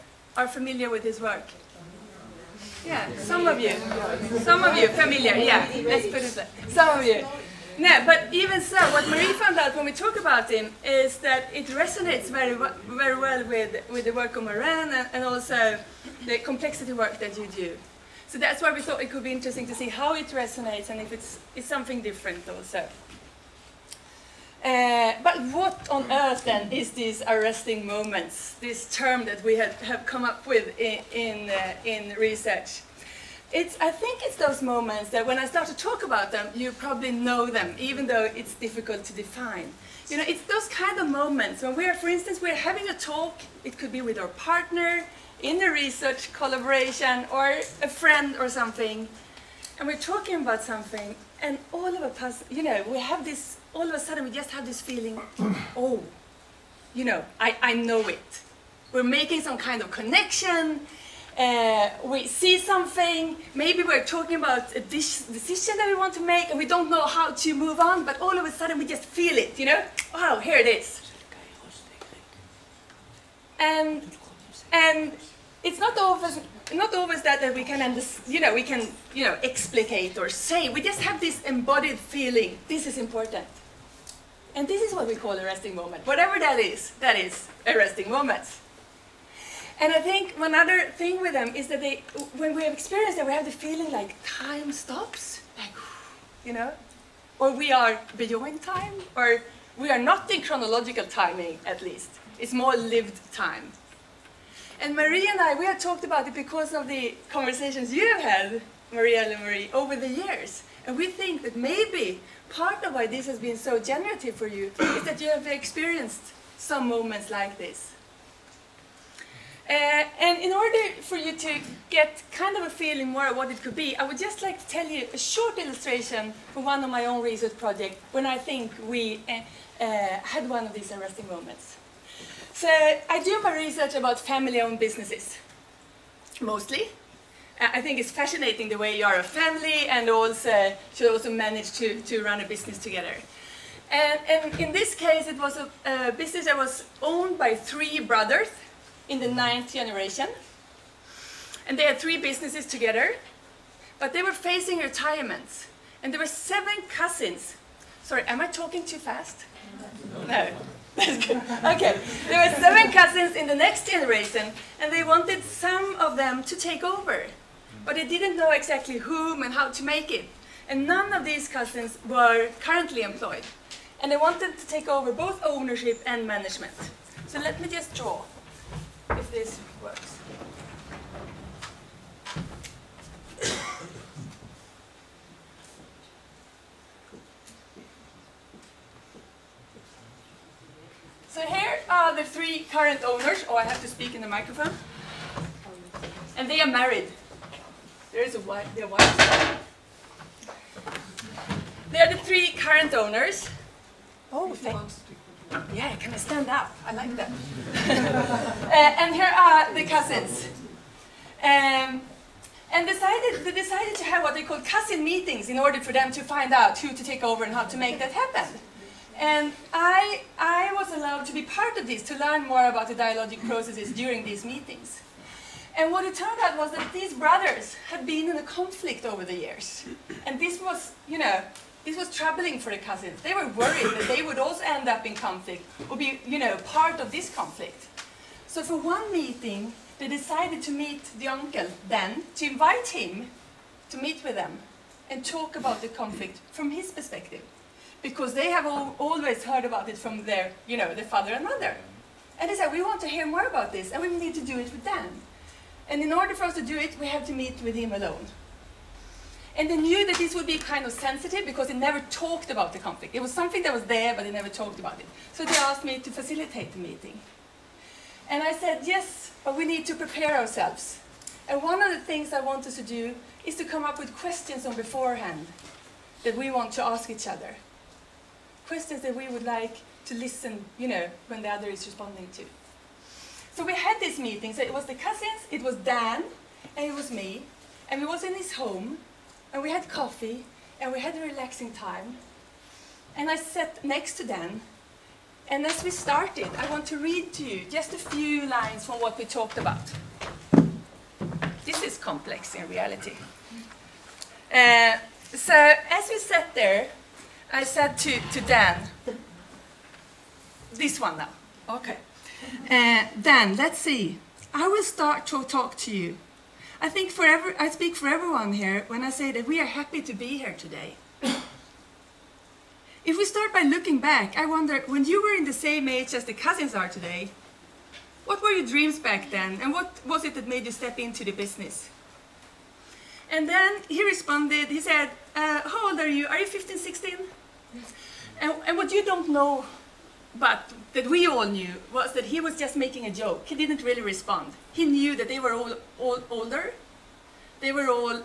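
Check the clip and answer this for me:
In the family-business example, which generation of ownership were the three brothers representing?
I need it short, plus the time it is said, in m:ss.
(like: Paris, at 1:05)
ninth, at 2:29.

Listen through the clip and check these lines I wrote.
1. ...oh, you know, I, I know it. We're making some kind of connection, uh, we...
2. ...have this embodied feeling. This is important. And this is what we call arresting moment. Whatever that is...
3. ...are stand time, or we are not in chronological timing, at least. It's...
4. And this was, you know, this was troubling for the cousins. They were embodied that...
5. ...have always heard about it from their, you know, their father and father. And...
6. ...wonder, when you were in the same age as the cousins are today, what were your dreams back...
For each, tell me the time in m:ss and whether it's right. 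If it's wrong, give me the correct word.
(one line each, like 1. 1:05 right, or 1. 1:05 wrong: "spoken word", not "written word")
1. 0:55 right
2. 1:21 right
3. 1:37 wrong: "beyond", not "stand"
4. 3:50 wrong: "worried", not "embodied"
5. 4:08 wrong: "mother", not "father"
6. 5:24 right.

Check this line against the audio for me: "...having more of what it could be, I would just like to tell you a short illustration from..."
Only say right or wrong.
wrong.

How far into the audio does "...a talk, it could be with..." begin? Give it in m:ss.
0:42.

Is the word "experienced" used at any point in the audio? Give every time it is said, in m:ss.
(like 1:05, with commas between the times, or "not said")
1:32, 1:55.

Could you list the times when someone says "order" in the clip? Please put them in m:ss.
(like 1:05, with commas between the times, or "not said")
2:00, 3:35, 4:16.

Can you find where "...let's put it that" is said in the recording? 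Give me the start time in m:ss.
0:05.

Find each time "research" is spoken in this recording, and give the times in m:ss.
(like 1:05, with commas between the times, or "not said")
0:32, 0:45, 2:07, 2:13.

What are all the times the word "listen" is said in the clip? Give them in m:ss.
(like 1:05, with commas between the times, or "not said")
4:40.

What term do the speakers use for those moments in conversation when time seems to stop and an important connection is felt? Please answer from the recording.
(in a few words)
arresting moments.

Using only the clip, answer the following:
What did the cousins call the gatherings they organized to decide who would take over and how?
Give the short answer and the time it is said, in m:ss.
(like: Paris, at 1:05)
cousin meetings, at 3:34.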